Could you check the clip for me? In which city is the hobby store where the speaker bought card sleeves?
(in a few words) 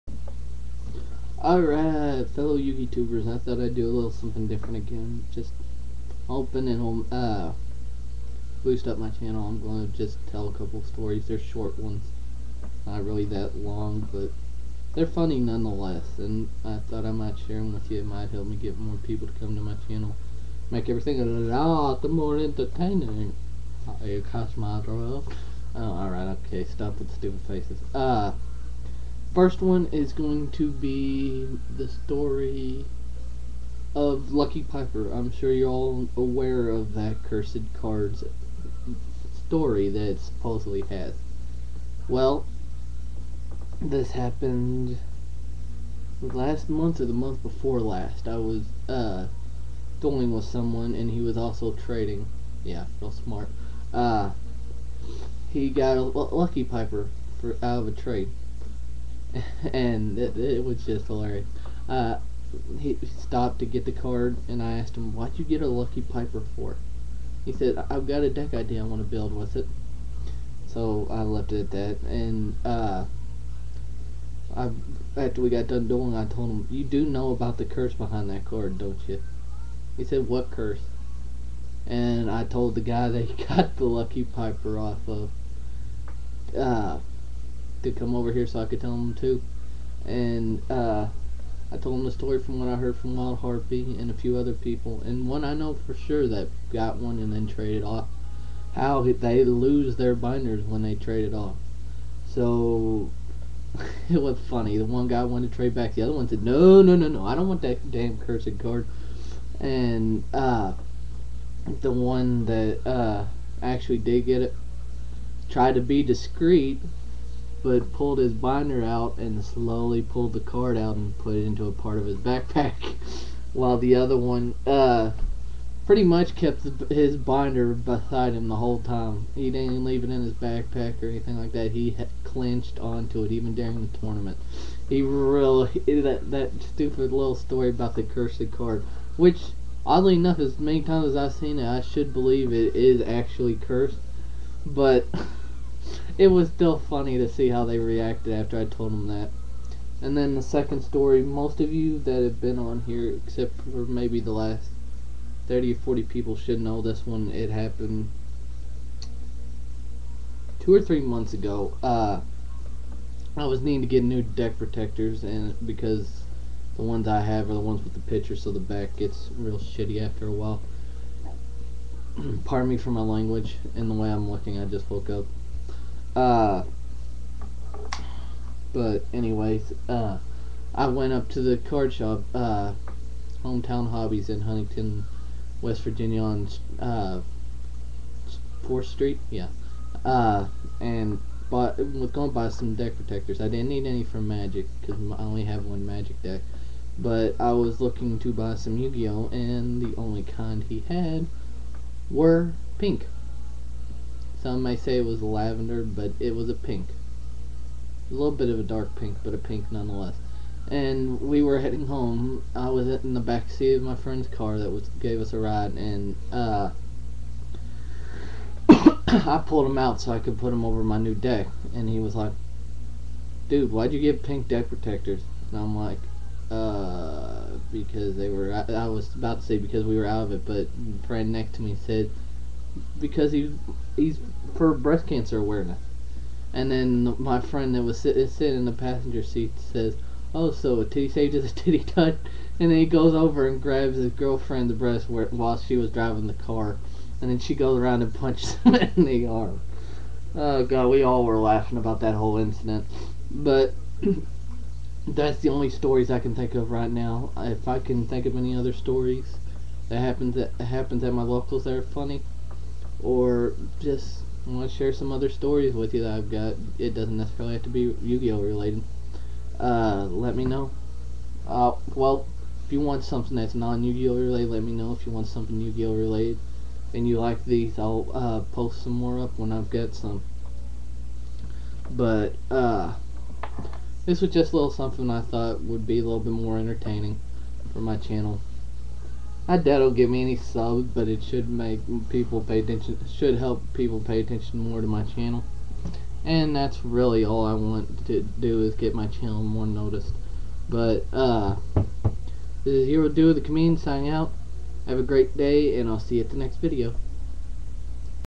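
Huntington, West Virginia.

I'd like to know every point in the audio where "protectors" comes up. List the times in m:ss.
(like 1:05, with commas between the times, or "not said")
2:44, 3:12, 3:44.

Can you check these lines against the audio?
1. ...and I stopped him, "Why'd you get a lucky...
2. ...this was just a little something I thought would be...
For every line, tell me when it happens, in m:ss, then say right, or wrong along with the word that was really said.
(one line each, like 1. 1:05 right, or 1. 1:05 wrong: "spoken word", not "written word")
1. 1:04 wrong: "asked", not "stopped"
2. 4:44 right.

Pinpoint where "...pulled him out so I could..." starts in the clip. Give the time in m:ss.
3:39.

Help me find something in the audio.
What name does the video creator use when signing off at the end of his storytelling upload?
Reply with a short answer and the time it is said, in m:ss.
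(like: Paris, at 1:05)
Heroduothecomedian, at 5:02.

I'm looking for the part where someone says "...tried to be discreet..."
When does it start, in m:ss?
1:55.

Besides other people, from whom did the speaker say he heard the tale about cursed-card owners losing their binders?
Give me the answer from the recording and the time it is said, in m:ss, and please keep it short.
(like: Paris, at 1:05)
Wild Harpy, at 1:33.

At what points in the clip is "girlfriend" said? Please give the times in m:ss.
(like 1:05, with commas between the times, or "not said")
4:04.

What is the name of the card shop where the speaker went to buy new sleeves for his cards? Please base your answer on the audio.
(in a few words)
Hometown Hobbies.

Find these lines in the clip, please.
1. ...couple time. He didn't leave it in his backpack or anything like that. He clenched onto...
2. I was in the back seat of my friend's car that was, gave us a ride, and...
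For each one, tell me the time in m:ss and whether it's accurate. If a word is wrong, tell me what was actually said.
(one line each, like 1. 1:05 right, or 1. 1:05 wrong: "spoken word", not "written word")
1. 2:08 wrong: "whole", not "couple"
2. 3:32 right.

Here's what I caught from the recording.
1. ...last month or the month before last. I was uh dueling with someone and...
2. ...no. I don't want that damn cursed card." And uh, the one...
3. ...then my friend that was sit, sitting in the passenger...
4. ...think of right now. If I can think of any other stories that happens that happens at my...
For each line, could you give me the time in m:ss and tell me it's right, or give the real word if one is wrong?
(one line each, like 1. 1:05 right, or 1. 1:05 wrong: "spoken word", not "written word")
1. 0:46 right
2. 1:47 right
3. 3:56 right
4. 4:16 right.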